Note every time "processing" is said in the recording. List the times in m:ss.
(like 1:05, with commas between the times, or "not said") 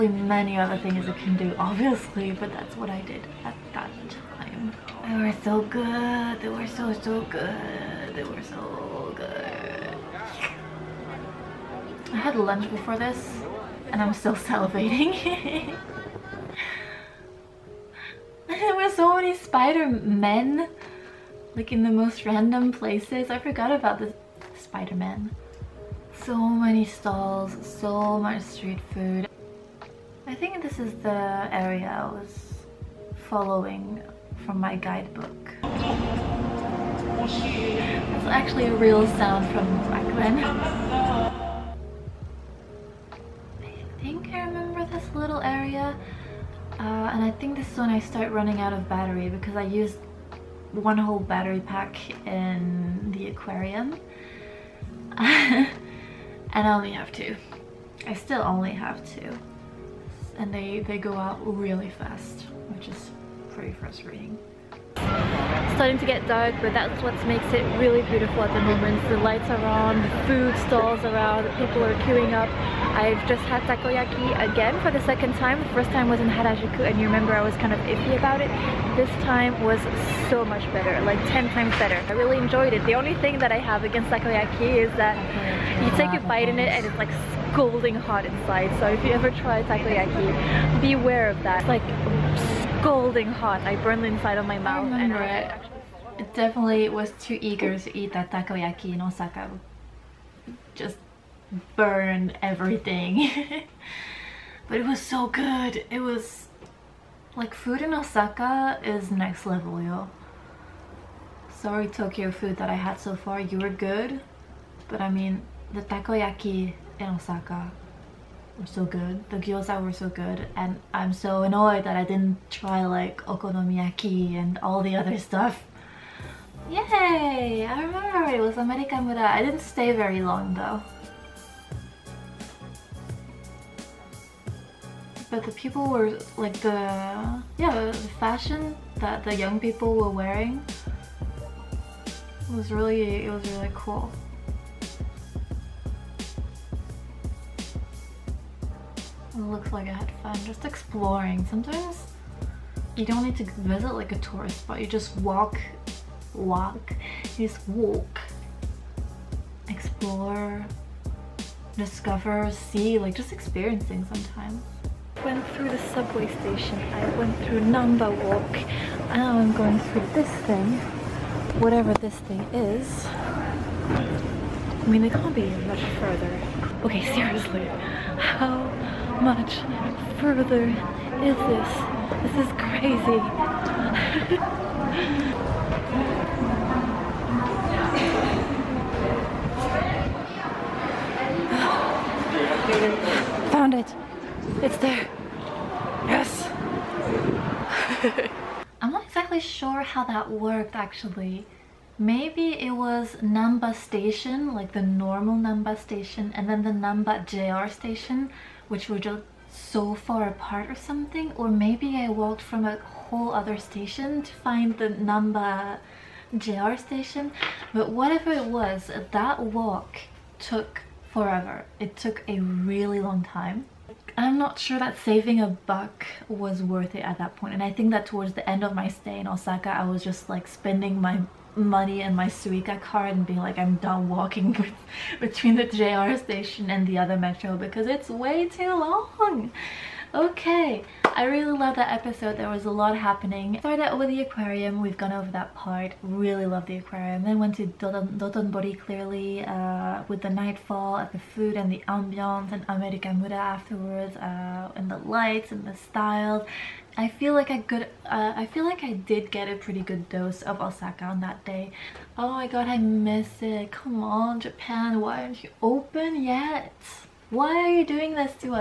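not said.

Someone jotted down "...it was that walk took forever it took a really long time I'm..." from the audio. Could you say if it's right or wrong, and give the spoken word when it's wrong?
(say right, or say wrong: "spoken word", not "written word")
right.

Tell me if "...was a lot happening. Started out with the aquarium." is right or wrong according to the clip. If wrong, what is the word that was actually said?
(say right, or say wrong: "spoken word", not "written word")
right.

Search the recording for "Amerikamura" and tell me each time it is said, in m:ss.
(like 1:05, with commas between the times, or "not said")
2:08, 4:12.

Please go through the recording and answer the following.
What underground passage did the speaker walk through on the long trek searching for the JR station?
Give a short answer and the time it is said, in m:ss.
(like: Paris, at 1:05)
Namba Walk, at 2:47.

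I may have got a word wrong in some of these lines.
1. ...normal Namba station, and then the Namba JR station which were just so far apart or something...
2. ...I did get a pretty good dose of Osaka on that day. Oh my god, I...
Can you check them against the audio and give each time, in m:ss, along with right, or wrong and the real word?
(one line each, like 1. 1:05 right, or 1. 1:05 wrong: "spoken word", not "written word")
1. 3:24 right
2. 4:18 right.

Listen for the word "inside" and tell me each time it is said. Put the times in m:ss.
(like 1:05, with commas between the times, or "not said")
1:28, 1:34.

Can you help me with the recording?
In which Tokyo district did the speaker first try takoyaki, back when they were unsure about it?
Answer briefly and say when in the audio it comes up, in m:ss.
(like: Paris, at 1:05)
Harajuku, at 1:16.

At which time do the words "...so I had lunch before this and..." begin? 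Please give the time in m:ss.
0:08.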